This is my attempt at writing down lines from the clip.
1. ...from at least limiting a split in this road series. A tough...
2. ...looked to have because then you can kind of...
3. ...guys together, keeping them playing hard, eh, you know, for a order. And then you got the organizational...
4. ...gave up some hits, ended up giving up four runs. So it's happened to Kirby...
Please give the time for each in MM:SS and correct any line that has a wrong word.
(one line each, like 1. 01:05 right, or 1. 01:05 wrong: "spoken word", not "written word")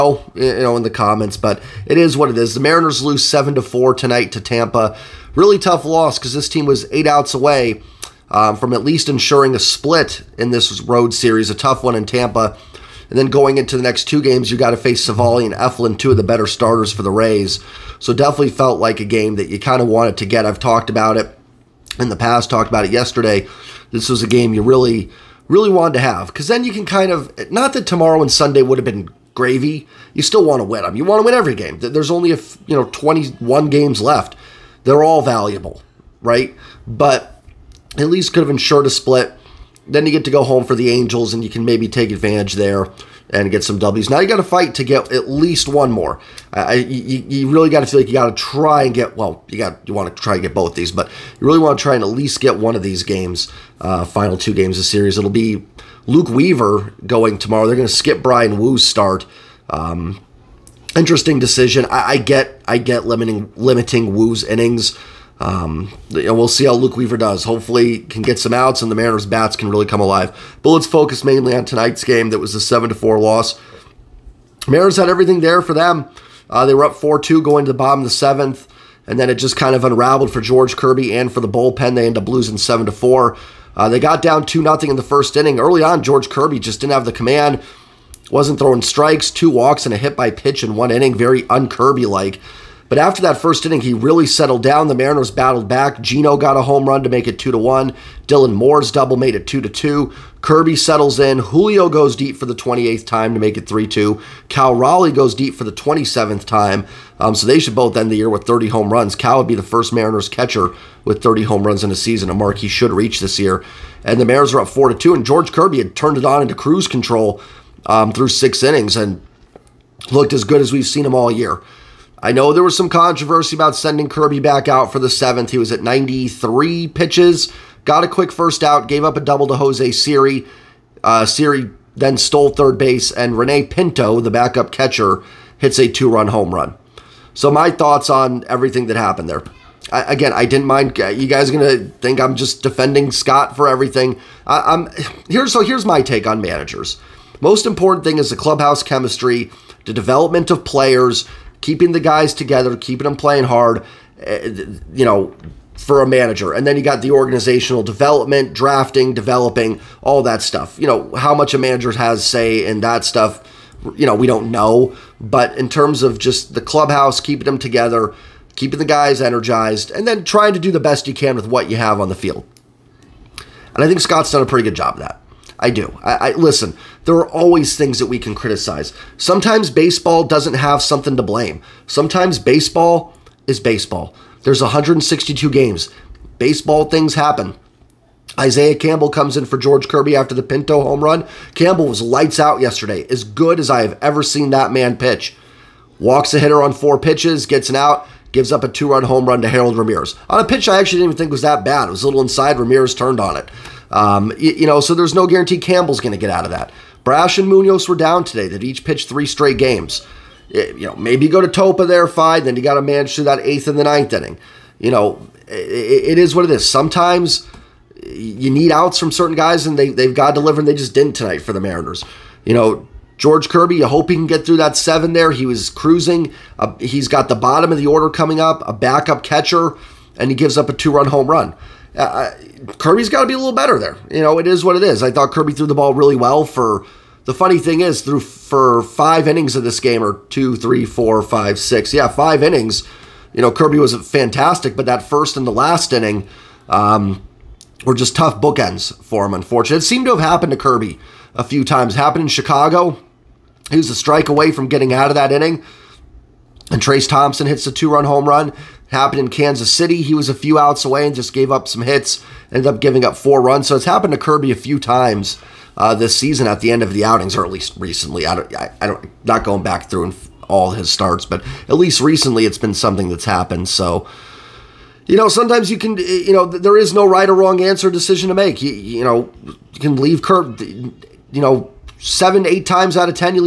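1. 00:08 wrong: "ensuring", not "limiting"
2. 00:25 wrong: "wanted", not "looked"
3. 02:32 wrong: "manager", not "order"
4. 04:21 right.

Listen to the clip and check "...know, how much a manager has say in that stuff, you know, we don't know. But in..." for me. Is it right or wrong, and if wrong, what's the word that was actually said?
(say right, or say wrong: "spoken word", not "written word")
right.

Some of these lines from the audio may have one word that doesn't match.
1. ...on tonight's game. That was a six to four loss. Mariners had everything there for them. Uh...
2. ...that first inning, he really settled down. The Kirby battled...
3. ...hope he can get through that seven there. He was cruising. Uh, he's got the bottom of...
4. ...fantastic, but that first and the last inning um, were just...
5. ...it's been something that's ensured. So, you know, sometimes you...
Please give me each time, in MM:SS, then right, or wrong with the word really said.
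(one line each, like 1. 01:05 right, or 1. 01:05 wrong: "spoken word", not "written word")
1. 01:11 wrong: "seven", not "six"
2. 01:33 wrong: "Mariners", not "Kirby"
3. 03:43 right
4. 04:04 right
5. 04:32 wrong: "happened", not "ensured".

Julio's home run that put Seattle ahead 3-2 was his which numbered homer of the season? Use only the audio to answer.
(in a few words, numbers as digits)
28th.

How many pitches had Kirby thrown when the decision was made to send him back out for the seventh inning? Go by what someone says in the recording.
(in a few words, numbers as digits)
93.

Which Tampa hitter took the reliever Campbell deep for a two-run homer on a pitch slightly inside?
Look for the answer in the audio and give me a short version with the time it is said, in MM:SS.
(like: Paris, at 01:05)
Harold Ramirez, at 03:19.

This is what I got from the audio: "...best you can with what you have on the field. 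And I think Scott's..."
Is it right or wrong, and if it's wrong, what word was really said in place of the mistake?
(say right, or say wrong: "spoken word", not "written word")
right.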